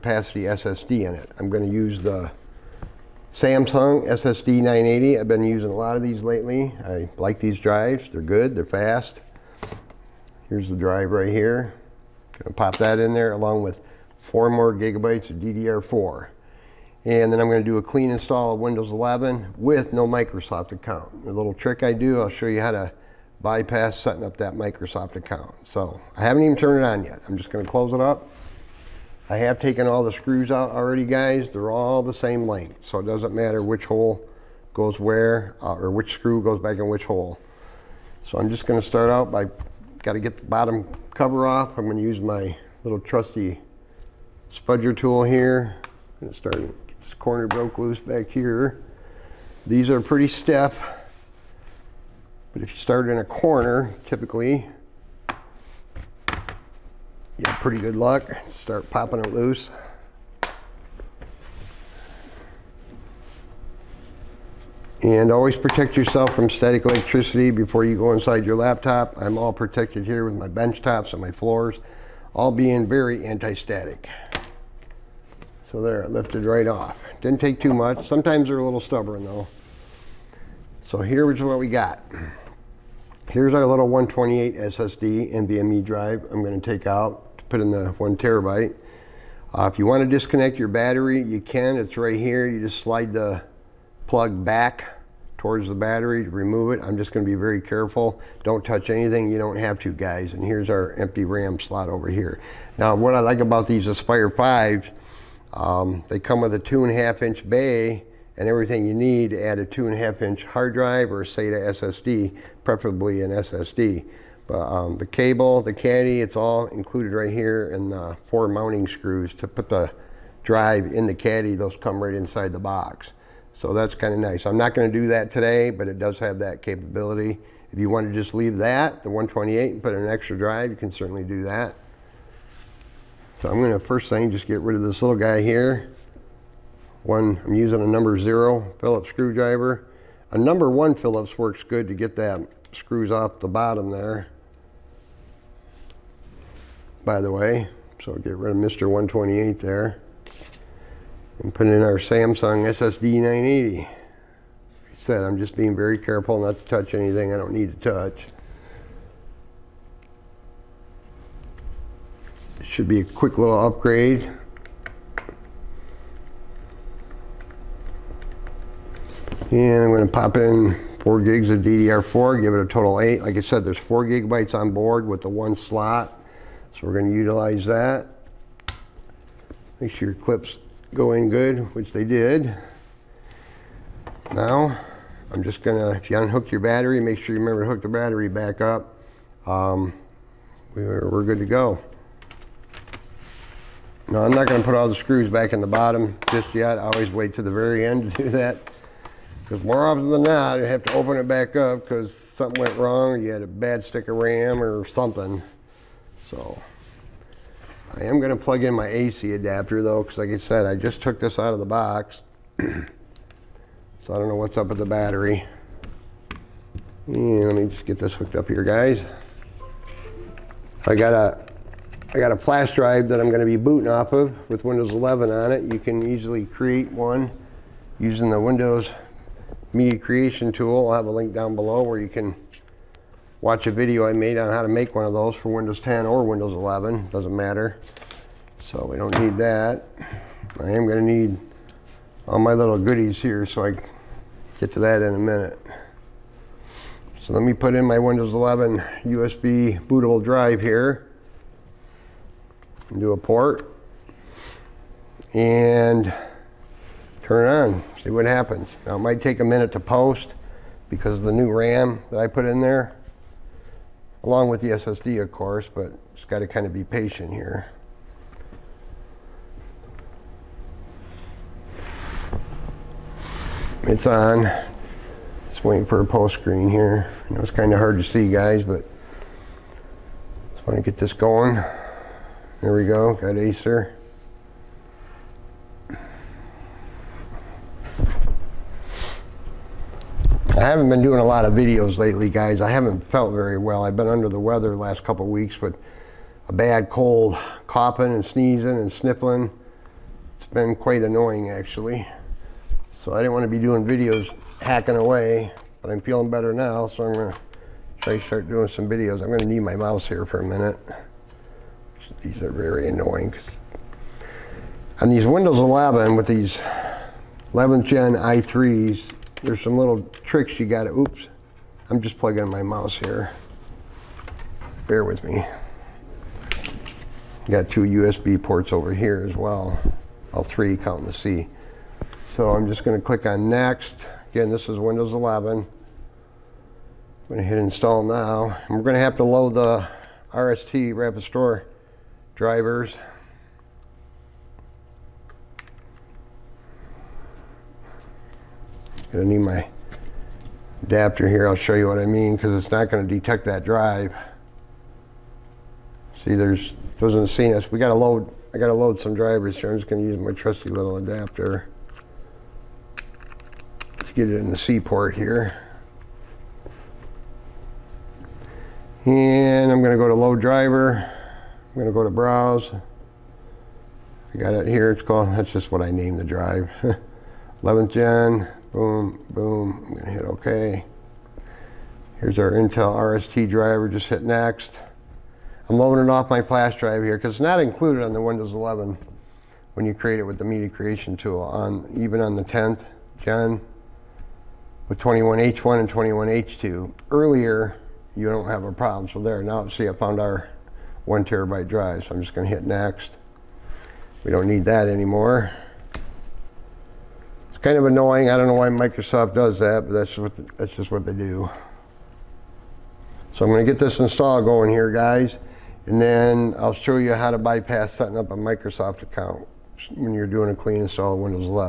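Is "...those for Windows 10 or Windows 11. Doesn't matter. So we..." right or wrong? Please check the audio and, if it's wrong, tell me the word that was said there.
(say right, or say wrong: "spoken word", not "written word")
right.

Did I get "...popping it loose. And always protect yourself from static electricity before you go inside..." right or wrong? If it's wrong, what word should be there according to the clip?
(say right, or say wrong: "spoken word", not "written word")
right.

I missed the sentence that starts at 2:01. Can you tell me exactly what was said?
Those come right inside the box.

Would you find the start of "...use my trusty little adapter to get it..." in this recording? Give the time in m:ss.
6:00.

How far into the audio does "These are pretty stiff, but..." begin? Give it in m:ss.
0:49.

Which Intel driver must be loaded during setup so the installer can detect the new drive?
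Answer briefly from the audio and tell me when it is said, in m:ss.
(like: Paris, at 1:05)
Intel RST, at 6:22.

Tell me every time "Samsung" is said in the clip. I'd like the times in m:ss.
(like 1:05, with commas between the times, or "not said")
0:03, 2:31.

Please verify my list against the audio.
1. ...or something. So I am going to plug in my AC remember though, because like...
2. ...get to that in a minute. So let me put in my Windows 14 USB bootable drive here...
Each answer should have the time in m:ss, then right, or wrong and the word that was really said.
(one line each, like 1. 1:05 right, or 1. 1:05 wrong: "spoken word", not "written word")
1. 3:24 wrong: "adapter", not "remember"
2. 4:04 wrong: "11", not "14".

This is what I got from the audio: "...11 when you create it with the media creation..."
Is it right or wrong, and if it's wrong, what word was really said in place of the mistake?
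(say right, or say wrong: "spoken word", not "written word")
right.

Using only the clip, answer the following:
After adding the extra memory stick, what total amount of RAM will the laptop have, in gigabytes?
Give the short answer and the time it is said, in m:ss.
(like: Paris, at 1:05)
8, at 2:53.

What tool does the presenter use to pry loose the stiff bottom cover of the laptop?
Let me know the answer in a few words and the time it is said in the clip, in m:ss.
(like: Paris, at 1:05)
spudger, at 0:44.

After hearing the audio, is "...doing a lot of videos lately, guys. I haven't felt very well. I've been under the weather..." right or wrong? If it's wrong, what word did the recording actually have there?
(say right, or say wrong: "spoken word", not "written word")
right.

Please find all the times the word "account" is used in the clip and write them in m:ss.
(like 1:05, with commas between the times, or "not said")
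0:20, 0:25, 6:59.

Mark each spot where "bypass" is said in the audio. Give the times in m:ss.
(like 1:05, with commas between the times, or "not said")
0:23, 6:57.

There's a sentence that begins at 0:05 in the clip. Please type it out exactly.
I've been using a lot of these lately.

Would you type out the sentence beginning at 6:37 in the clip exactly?
Earlier, you don't have a problem.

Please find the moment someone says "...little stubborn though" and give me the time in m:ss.
1:18.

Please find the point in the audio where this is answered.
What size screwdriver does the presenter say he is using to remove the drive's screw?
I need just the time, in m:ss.
2:17.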